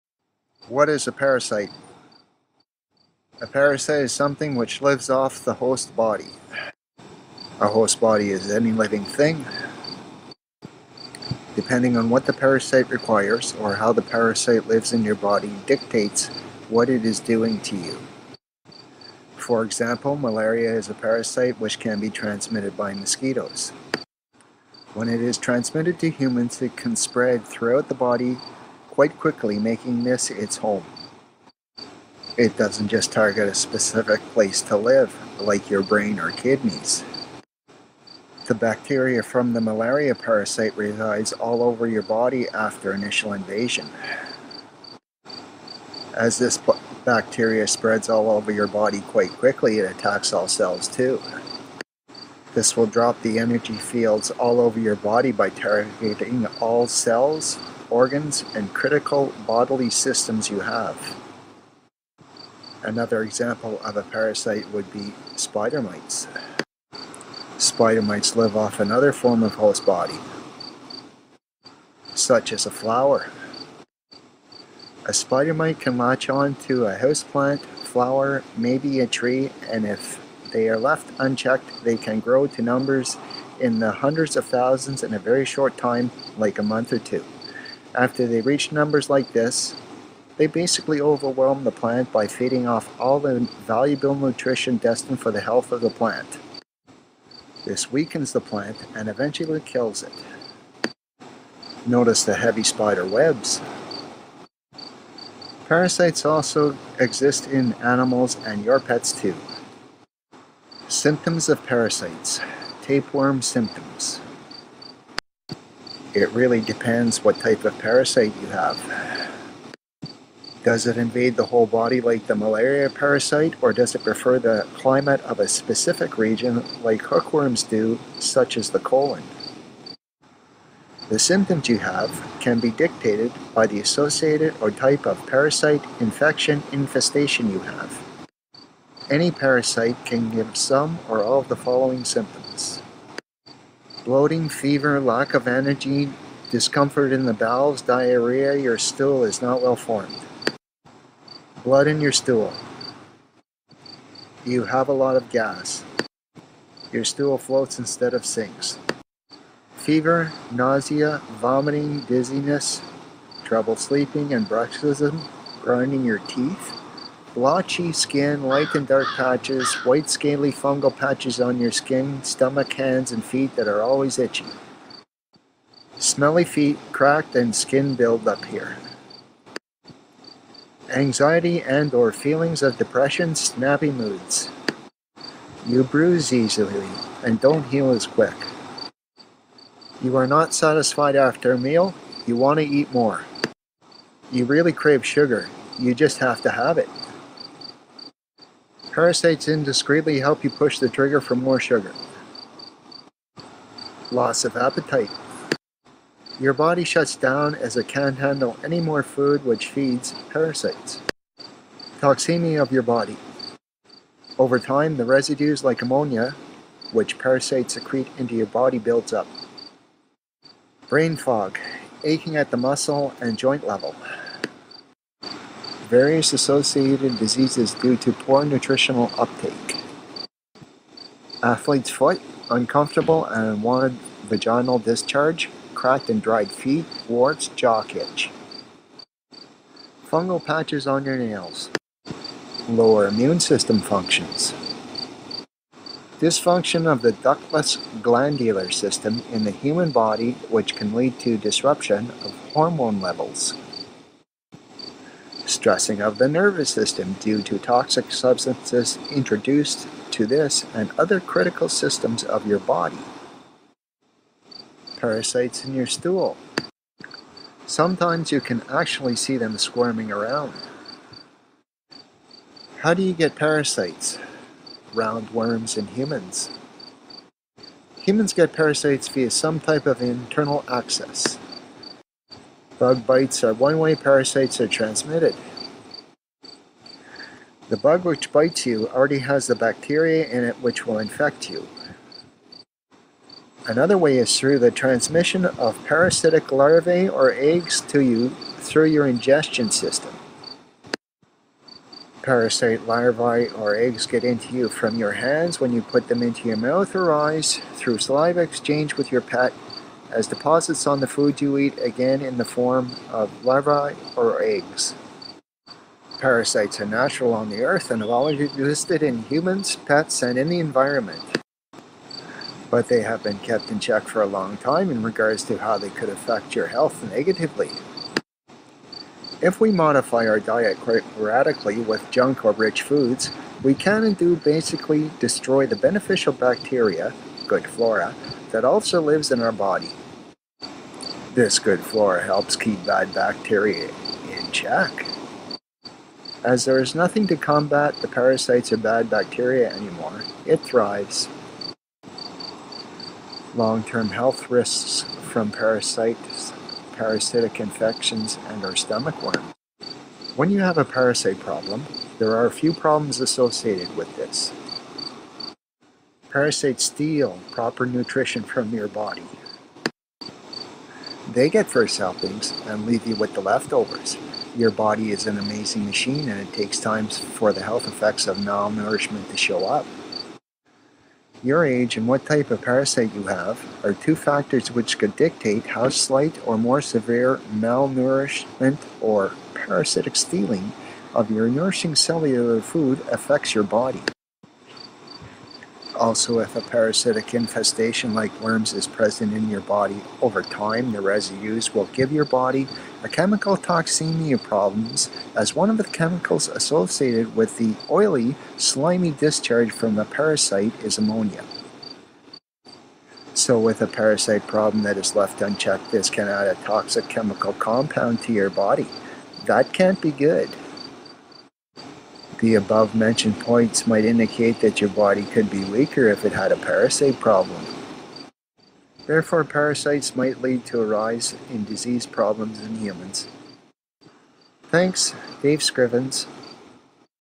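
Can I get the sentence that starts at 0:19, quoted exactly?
For example, malaria is a parasite which can be transmitted by mosquitoes.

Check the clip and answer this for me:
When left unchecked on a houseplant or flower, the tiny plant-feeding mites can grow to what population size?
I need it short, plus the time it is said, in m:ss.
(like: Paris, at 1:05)
hundreds of thousands, at 1:23.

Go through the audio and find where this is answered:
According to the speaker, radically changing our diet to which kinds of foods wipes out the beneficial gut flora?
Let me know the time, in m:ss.
5:32.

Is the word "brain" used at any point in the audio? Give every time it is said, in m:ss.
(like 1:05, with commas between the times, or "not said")
0:35, 3:40.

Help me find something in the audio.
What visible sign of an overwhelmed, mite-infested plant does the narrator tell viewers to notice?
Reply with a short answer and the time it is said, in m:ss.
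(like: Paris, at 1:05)
heavy spider webs, at 1:42.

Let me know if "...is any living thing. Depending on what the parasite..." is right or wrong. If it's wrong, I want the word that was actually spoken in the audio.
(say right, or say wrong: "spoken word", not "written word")
right.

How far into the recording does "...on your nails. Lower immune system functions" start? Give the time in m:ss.
4:00.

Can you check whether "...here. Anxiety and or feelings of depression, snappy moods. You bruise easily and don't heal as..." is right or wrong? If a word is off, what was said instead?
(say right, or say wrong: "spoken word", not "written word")
right.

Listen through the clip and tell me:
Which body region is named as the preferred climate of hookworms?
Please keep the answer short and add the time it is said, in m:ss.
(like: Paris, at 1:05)
the colon, at 2:08.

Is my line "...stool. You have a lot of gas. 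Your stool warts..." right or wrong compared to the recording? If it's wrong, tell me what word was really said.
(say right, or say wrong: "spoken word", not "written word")
wrong: "floats", not "warts".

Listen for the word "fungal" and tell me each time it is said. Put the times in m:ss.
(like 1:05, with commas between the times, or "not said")
2:50, 4:00.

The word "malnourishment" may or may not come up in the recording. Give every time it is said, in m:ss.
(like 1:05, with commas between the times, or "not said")
6:18, 6:27.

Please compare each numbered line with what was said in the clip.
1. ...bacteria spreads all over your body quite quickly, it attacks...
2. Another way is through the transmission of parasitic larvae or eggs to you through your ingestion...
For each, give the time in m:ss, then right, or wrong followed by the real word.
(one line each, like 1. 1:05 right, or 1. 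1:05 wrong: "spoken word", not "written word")
1. 0:47 right
2. 4:53 right.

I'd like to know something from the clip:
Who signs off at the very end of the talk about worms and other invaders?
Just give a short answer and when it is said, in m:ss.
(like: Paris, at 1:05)
Dave Scrivens, at 7:15.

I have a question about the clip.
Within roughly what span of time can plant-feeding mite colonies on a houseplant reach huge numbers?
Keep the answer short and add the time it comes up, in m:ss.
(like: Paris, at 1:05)
a month or two, at 1:26.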